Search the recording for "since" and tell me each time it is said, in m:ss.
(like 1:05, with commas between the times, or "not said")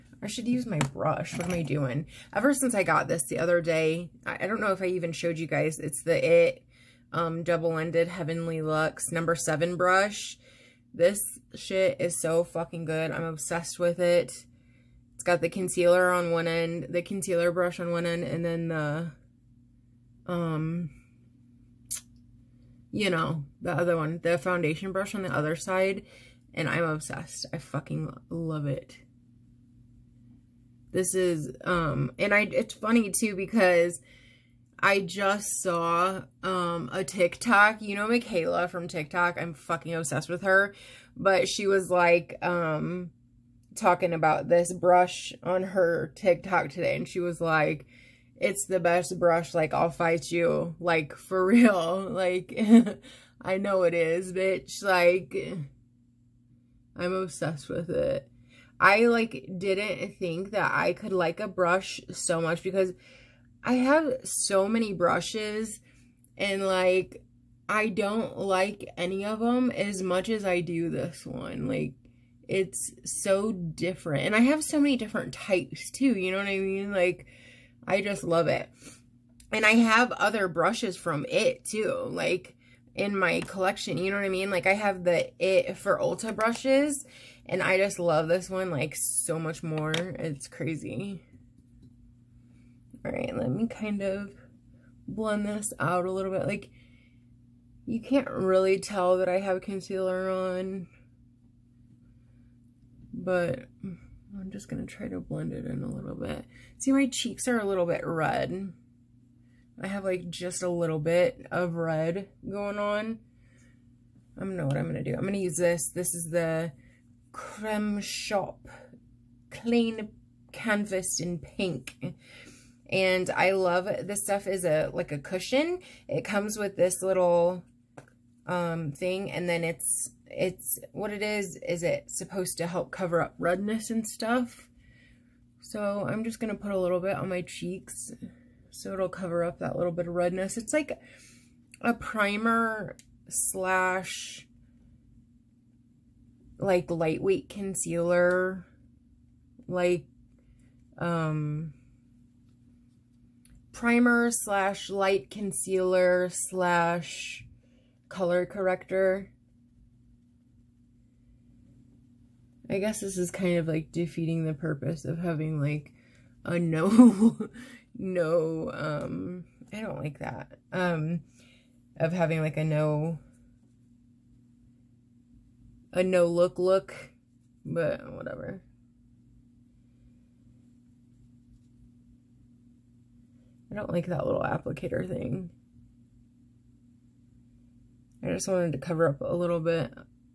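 0:02.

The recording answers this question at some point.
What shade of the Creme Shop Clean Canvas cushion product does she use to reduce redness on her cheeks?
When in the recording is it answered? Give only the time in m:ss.
2:01.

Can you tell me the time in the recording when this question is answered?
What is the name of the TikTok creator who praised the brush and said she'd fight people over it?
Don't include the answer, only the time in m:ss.
0:38.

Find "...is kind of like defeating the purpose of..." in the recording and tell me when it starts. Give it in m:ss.
2:43.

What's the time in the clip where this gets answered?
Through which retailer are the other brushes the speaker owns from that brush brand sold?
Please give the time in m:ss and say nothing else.
1:25.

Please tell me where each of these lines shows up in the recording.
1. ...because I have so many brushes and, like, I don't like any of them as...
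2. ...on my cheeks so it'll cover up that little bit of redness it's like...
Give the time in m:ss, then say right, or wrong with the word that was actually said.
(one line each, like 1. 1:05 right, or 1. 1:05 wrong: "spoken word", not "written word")
1. 1:02 right
2. 2:17 right.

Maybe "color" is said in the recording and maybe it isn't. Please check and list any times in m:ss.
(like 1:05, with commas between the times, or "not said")
2:38.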